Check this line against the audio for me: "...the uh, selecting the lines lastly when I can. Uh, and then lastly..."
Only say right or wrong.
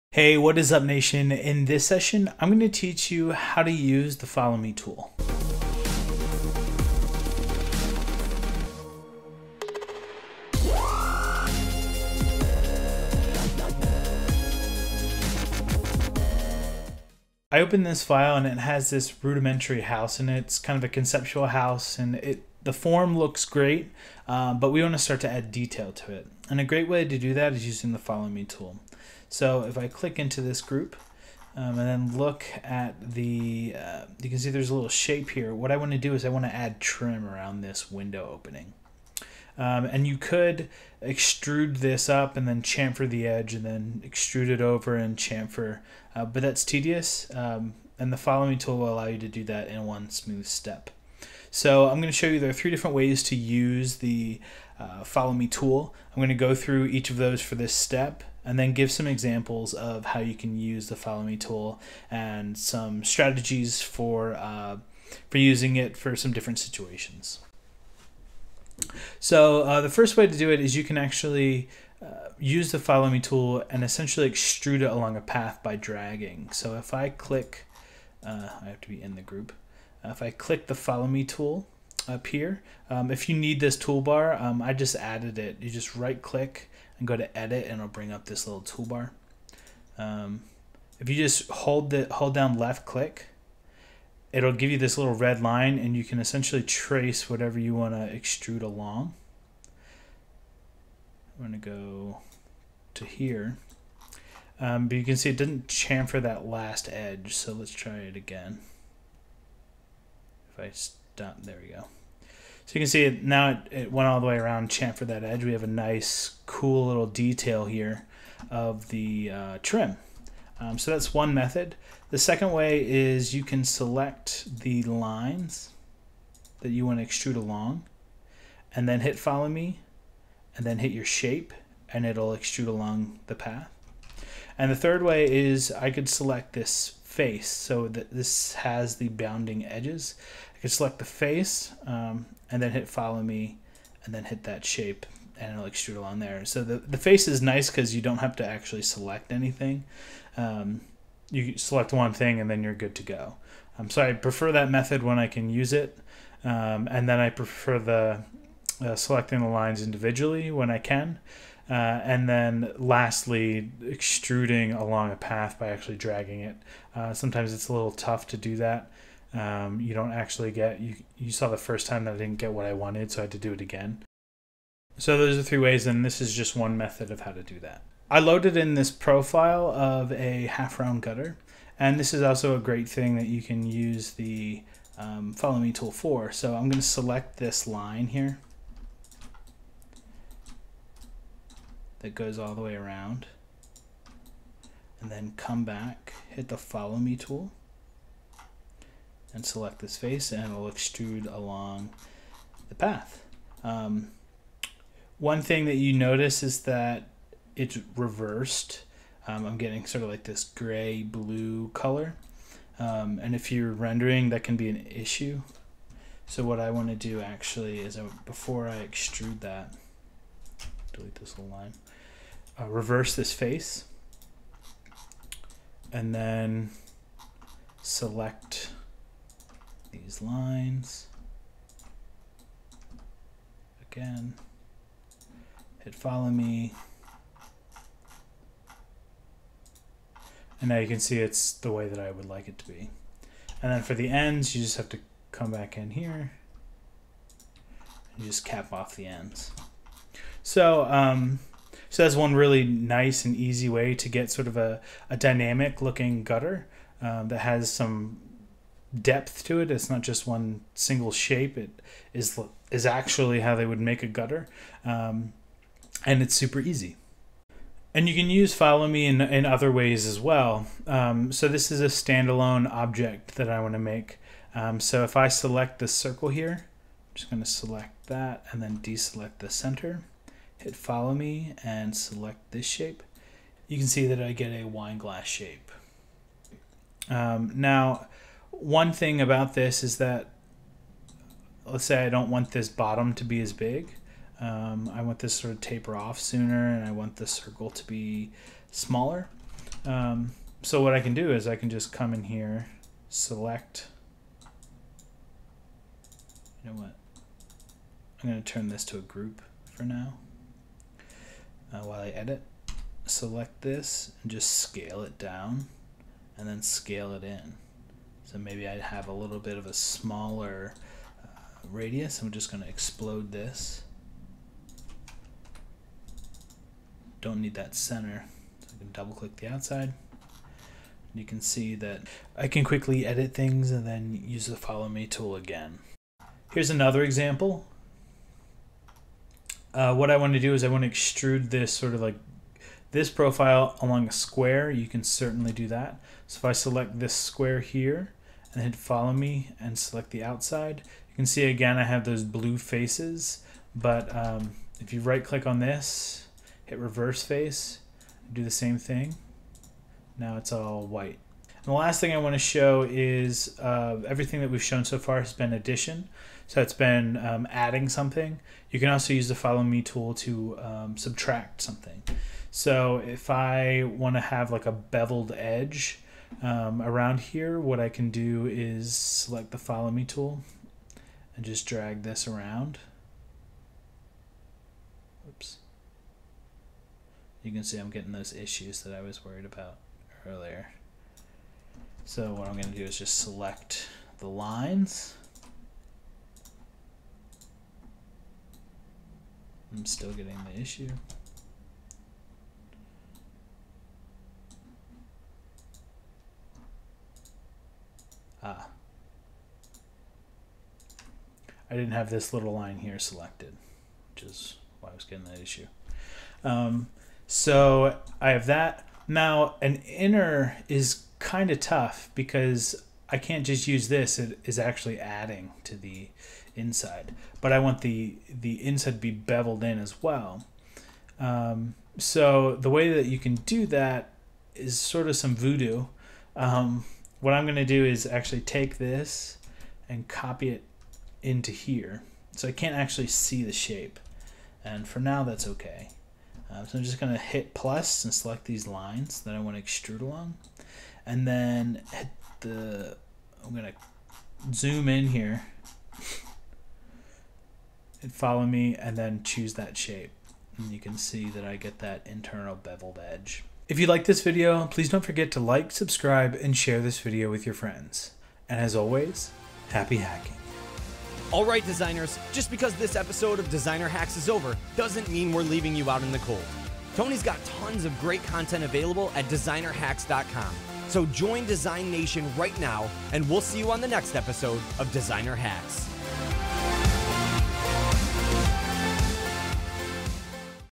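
wrong.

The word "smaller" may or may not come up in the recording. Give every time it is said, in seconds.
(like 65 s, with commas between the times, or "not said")
298 s, 319 s.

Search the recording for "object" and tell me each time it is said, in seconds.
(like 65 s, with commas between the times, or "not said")
272 s.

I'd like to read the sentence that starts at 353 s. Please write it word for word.
But um, if you right click on this, hit reverse face, do the same thing.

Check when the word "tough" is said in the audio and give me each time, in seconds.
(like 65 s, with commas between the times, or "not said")
167 s, 421 s.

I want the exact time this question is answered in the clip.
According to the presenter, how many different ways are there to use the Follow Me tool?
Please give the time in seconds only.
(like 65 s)
52 s.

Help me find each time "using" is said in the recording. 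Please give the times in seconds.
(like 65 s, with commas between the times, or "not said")
27 s, 65 s.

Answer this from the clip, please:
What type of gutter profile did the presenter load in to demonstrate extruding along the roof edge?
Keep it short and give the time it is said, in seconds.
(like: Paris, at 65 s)
half round gutter, at 180 s.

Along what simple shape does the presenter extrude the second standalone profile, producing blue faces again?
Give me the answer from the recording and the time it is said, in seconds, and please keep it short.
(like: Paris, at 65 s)
a square, at 344 s.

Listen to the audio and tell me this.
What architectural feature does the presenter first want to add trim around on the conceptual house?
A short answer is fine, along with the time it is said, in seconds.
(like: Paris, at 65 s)
window opening, at 37 s.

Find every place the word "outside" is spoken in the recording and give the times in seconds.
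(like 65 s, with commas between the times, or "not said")
329 s, 350 s.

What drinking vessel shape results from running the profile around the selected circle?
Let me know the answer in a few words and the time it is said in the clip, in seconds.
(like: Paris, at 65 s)
wine glass, at 284 s.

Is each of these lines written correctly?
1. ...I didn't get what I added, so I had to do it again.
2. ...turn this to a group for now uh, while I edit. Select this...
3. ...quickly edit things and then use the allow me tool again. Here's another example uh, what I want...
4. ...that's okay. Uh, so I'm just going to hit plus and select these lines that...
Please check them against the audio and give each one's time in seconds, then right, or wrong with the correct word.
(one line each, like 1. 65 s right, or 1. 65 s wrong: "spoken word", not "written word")
1. 172 s wrong: "wanted", not "added"
2. 308 s right
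3. 332 s wrong: "follow", not "allow"
4. 445 s right.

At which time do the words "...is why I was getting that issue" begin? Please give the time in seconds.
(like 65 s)
414 s.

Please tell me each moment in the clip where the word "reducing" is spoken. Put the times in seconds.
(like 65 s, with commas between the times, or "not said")
not said.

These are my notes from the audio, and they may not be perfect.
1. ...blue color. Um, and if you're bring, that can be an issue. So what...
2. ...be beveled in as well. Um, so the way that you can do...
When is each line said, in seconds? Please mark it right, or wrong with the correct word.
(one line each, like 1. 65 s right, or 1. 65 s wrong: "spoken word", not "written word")
1. 211 s wrong: "rendering", not "bring"
2. 428 s right.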